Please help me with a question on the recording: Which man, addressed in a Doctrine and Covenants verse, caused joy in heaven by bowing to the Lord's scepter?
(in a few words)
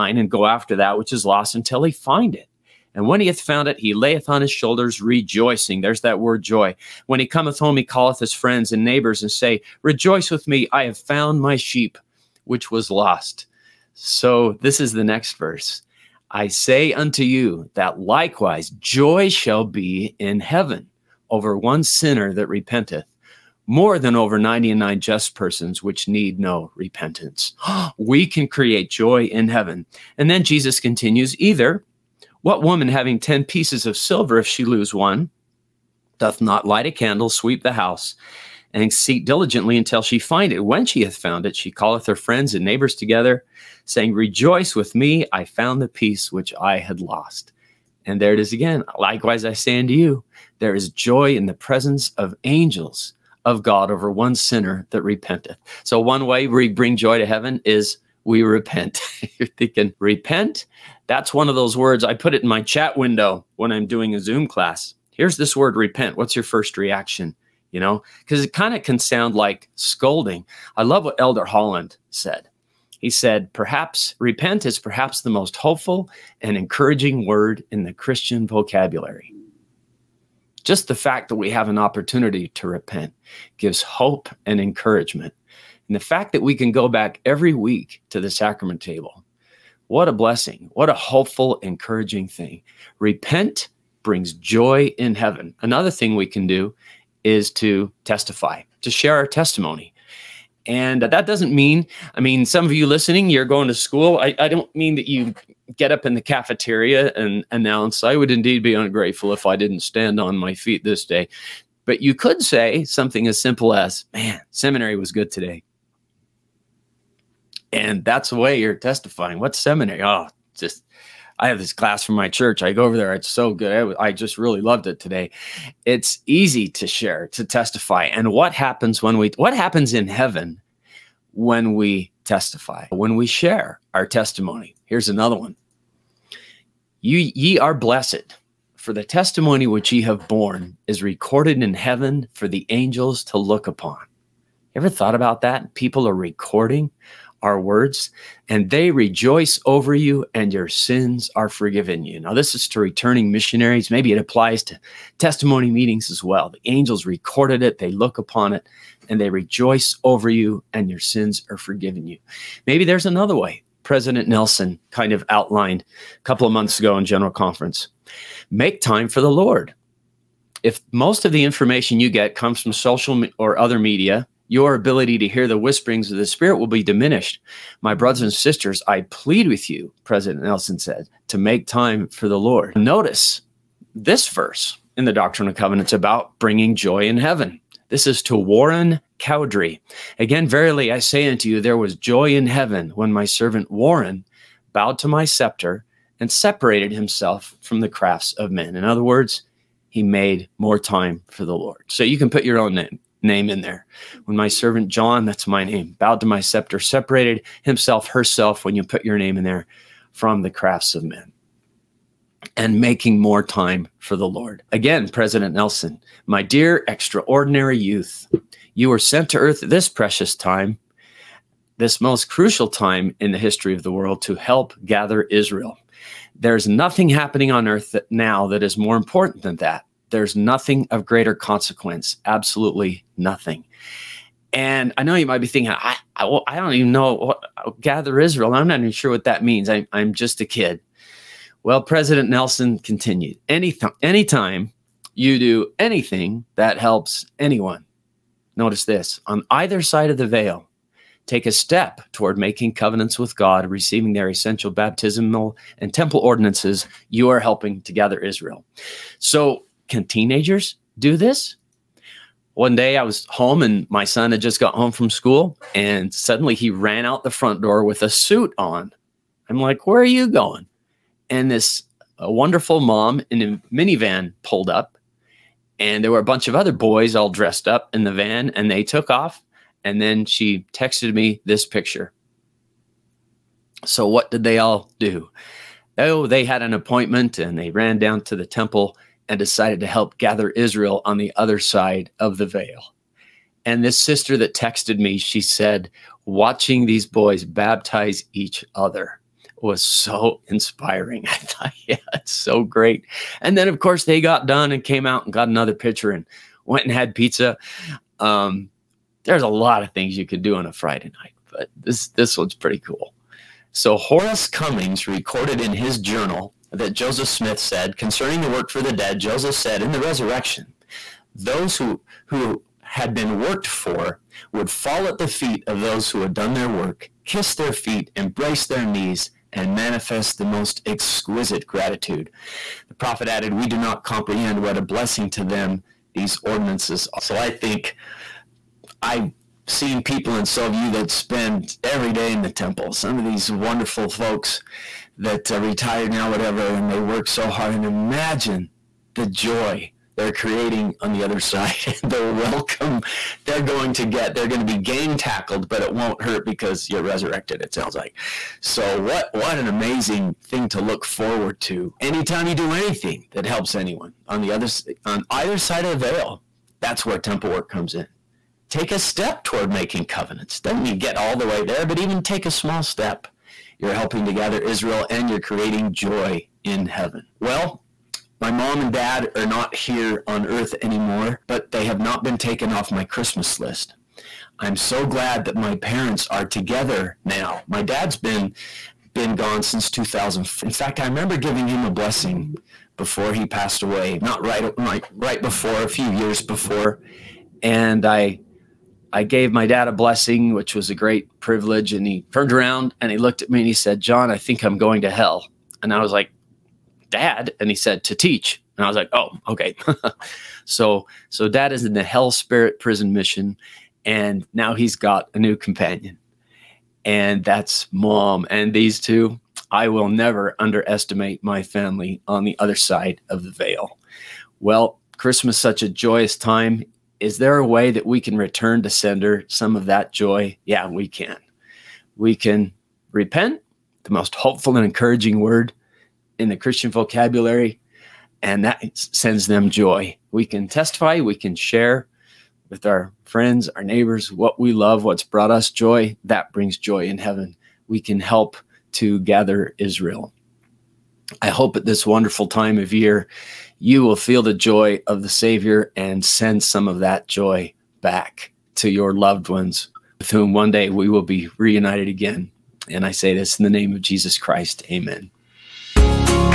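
Warren Cowdery.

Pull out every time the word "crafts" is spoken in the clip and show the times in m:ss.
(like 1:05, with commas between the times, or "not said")
3:17, 3:30.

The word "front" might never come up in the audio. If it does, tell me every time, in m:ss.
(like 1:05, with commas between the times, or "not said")
4:27.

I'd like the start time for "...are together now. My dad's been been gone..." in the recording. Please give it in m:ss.
6:26.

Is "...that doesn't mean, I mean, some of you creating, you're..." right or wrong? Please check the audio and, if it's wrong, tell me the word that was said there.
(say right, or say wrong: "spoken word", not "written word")
wrong: "listening", not "creating".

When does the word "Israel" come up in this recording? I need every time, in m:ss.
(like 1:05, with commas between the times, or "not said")
3:45, 3:58, 4:18, 4:50, 6:14, 7:29.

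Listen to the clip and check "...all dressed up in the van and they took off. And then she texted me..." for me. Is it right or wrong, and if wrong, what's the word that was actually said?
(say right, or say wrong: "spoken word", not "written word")
right.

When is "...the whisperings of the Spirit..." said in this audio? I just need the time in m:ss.
2:55.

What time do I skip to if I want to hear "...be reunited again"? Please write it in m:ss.
7:41.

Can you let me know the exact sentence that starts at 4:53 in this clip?
And this sister that texted me, she said, watching these boys baptize each other was so inspiring.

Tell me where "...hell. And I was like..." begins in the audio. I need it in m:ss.
6:45.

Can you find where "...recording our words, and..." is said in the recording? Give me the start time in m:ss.
2:26.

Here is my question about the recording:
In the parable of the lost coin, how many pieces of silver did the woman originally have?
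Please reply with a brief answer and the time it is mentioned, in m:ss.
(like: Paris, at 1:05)
10, at 0:33.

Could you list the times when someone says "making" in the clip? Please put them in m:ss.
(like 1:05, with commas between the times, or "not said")
3:32, 4:12, 6:09.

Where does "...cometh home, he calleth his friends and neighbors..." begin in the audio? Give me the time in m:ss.
0:07.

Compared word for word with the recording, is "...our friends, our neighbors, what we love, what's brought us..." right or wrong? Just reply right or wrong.
right.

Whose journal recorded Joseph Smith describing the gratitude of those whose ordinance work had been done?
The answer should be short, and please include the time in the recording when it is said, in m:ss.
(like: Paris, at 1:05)
Horace Cummings, at 5:13.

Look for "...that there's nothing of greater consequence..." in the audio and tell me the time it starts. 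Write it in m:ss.
3:49.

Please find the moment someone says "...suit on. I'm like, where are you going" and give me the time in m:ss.
4:28.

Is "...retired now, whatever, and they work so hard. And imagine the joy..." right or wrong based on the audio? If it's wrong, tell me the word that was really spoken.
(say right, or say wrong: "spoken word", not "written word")
right.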